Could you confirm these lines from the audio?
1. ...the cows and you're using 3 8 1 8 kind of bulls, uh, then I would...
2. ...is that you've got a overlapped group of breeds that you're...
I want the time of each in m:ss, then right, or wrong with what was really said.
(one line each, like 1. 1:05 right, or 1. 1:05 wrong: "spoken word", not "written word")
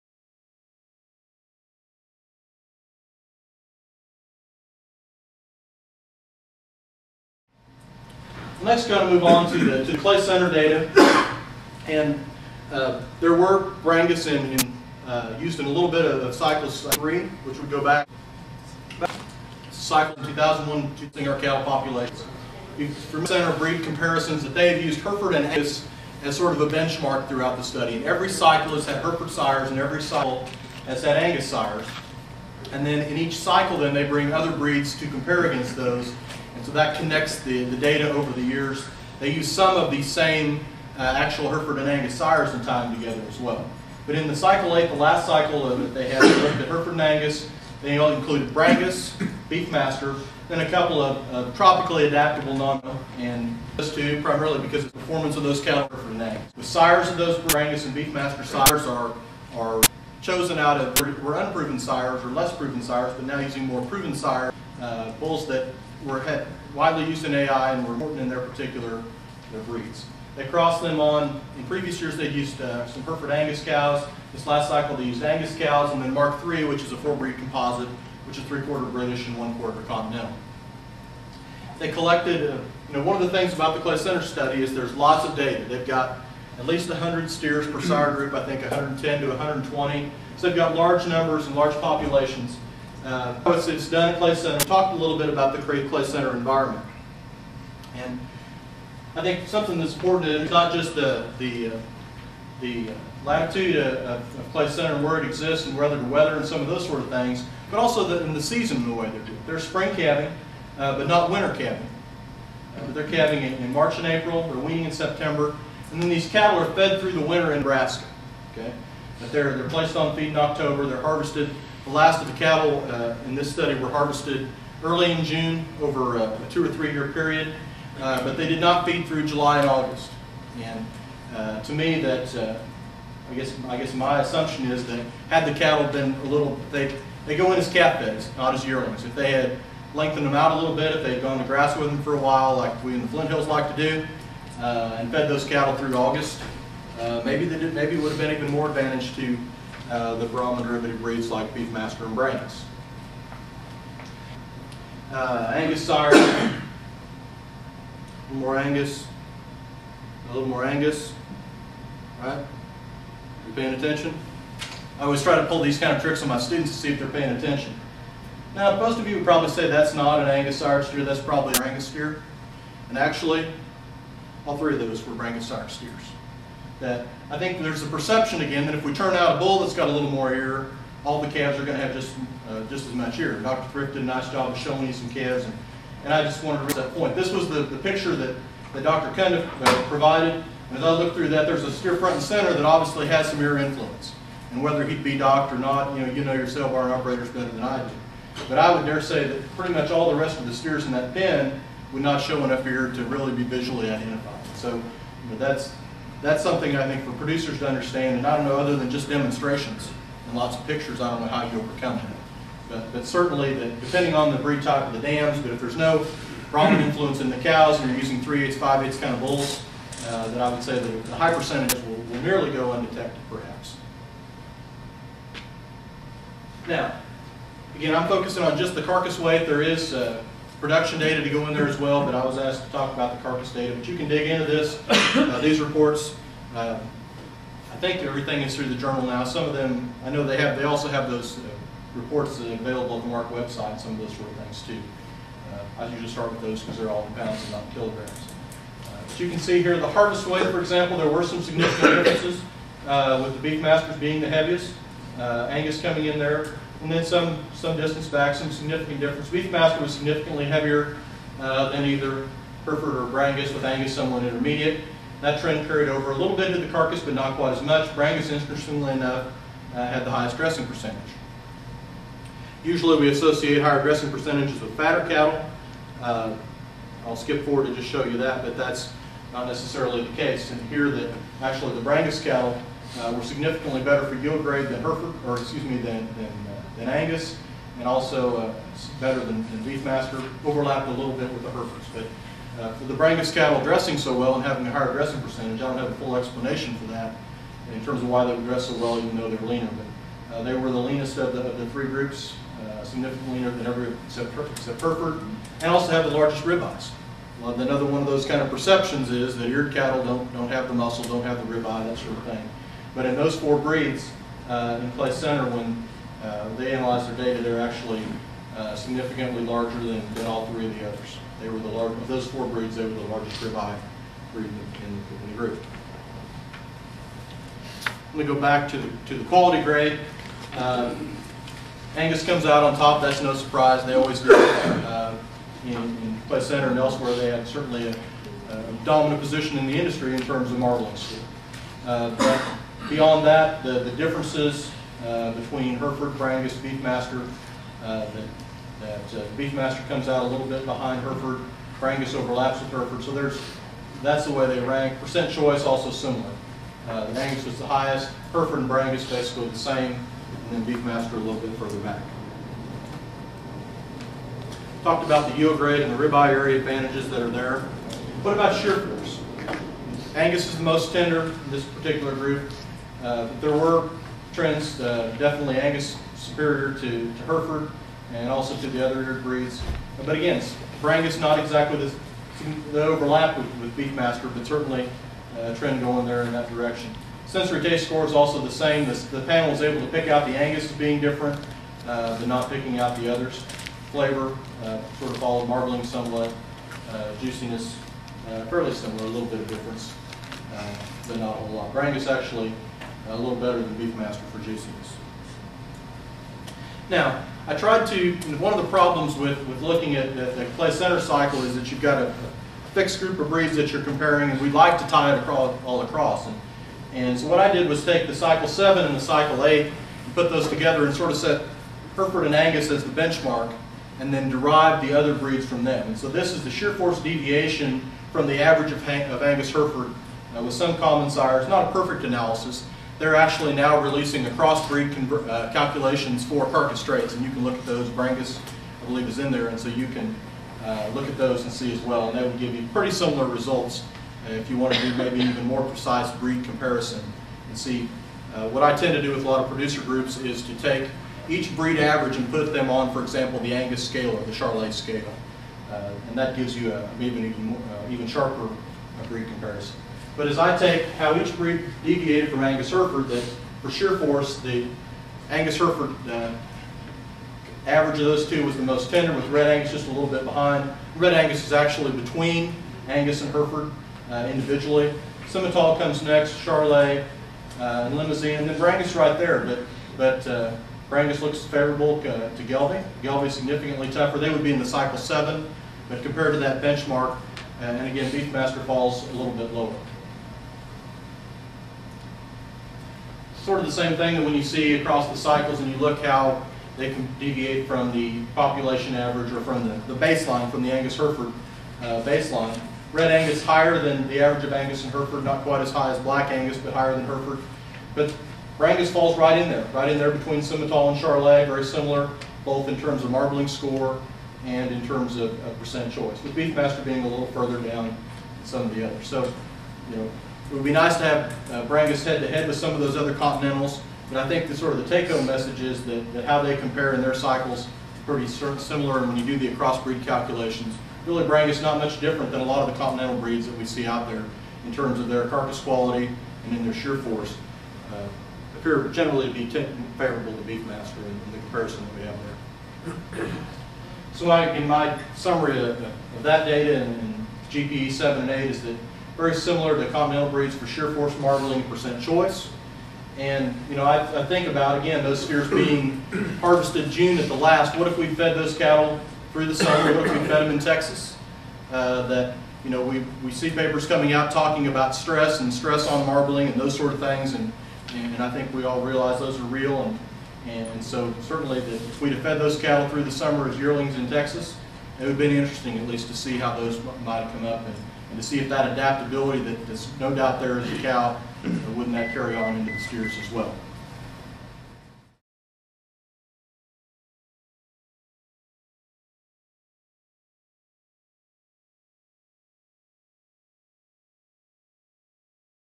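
1. 3:37 wrong: "5", not "1"
2. 6:51 wrong: "fixed", not "overlapped".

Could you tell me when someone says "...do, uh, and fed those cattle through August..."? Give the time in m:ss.
2:23.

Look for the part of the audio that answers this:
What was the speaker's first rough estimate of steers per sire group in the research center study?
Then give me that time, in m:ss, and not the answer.
1:26.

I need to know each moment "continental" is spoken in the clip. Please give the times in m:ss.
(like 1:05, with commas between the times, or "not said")
1:19, 8:43, 8:52, 9:09.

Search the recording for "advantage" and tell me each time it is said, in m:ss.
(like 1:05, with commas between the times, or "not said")
2:28, 6:06.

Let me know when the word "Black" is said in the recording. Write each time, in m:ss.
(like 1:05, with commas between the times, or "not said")
8:25.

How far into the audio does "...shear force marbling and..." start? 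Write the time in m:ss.
9:10.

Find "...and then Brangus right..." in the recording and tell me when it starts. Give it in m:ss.
7:58.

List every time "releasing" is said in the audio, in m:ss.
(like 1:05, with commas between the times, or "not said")
7:13.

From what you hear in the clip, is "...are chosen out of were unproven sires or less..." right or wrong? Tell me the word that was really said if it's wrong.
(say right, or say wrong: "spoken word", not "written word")
right.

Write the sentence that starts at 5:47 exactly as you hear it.
Uh, that, that uh, Beefmaster comes out a little bit behind Hereford.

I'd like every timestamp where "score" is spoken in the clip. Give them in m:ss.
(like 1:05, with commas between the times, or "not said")
6:27, 8:33.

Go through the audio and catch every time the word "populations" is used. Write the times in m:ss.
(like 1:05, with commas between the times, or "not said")
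0:21, 1:31, 8:18.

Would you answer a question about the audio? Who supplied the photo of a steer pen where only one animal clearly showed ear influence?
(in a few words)
Dr. Cundiff.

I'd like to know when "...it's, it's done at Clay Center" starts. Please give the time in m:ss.
1:33.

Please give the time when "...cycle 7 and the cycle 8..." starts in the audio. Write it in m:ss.
6:58.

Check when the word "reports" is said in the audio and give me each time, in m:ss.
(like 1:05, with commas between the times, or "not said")
3:55, 4:01.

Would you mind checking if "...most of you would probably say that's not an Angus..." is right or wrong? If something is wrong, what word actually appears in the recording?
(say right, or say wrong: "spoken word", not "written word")
right.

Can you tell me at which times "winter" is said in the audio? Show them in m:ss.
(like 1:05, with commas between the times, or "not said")
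1:51, 1:57.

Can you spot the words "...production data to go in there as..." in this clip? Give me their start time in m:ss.
3:50.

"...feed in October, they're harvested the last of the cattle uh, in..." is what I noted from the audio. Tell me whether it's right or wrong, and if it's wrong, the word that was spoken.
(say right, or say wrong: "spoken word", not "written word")
right.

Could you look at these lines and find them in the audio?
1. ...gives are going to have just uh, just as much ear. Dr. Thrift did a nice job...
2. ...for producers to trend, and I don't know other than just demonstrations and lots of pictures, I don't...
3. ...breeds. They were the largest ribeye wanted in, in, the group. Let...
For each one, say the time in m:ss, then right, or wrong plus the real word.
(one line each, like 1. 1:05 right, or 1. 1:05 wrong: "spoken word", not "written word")
1. 3:01 wrong: "calves", not "gives"
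2. 3:27 wrong: "understand", not "trend"
3. 5:22 wrong: "breed", not "wanted".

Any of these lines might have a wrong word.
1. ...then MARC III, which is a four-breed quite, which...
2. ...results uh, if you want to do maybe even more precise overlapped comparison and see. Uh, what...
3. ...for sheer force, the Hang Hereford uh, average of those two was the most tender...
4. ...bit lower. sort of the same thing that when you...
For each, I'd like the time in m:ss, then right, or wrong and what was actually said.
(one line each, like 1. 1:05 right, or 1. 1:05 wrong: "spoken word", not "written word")
1. 1:16 wrong: "composite", not "quite"
2. 7:23 wrong: "breed", not "overlapped"
3. 7:43 wrong: "Angus", not "Hang"
4. 8:09 right.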